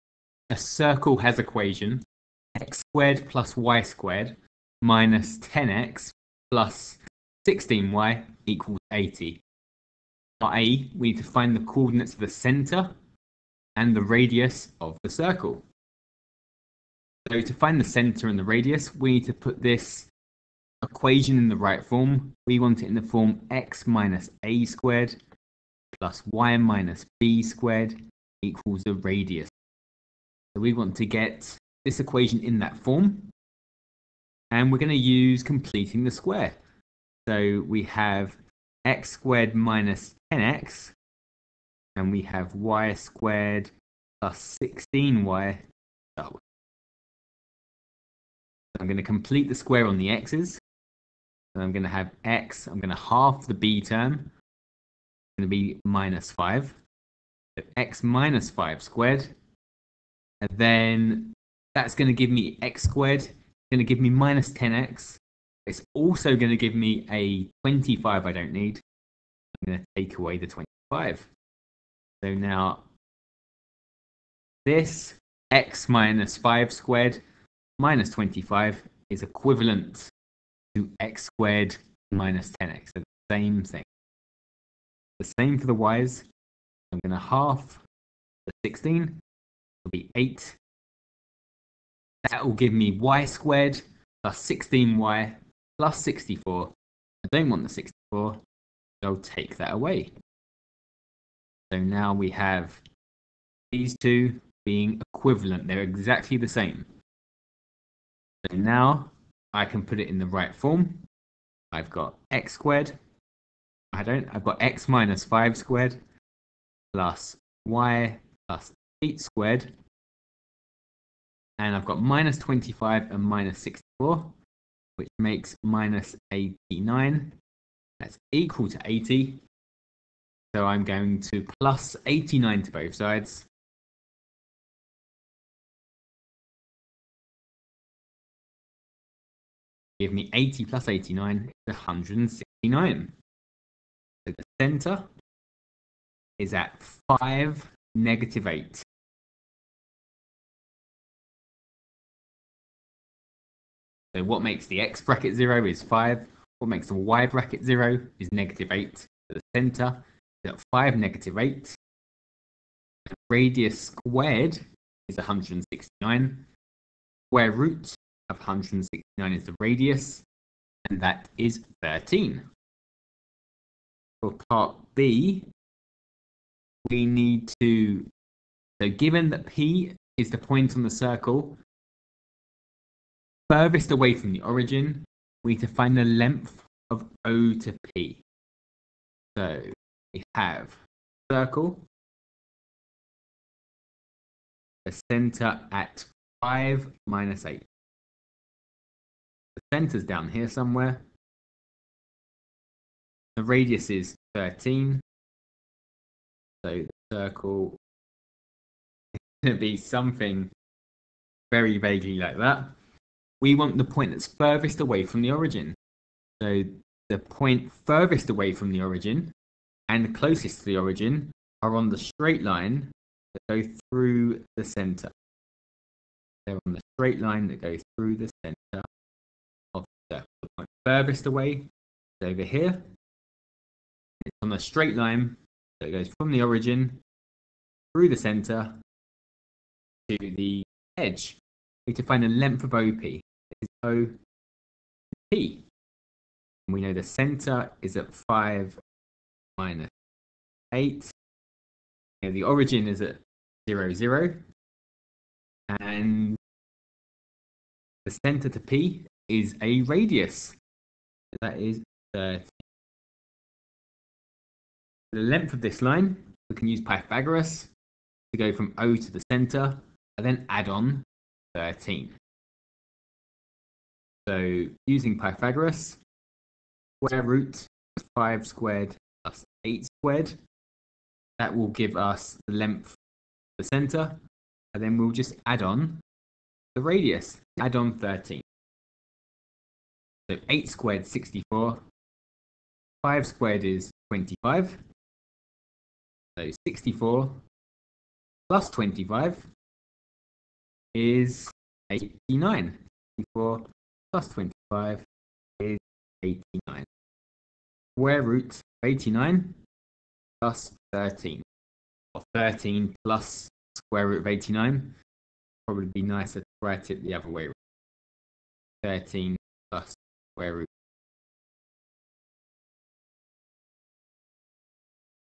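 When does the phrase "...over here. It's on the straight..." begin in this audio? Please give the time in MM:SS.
03:52.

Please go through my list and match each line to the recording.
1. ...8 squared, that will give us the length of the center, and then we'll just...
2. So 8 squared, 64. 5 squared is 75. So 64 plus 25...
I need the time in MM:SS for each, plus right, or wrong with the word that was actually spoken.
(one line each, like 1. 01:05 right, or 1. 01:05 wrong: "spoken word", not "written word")
1. 04:39 right
2. 04:50 wrong: "25", not "75".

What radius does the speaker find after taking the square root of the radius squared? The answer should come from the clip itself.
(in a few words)
13.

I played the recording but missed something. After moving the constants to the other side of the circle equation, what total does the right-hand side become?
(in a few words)
169.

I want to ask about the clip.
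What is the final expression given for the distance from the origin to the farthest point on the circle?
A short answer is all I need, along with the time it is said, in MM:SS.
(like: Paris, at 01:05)
13 + √89, at 05:12.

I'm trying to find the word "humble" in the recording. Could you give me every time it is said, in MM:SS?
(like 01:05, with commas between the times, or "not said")
not said.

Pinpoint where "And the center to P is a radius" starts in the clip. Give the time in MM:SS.
04:15.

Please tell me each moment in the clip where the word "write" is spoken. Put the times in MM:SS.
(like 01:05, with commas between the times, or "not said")
05:16.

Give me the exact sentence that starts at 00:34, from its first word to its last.
And we're going to use completing the square.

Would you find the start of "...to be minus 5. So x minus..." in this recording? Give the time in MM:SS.
00:55.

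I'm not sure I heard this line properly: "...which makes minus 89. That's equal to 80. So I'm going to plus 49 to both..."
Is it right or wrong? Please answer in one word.
wrong.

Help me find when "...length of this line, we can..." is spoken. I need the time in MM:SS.
04:25.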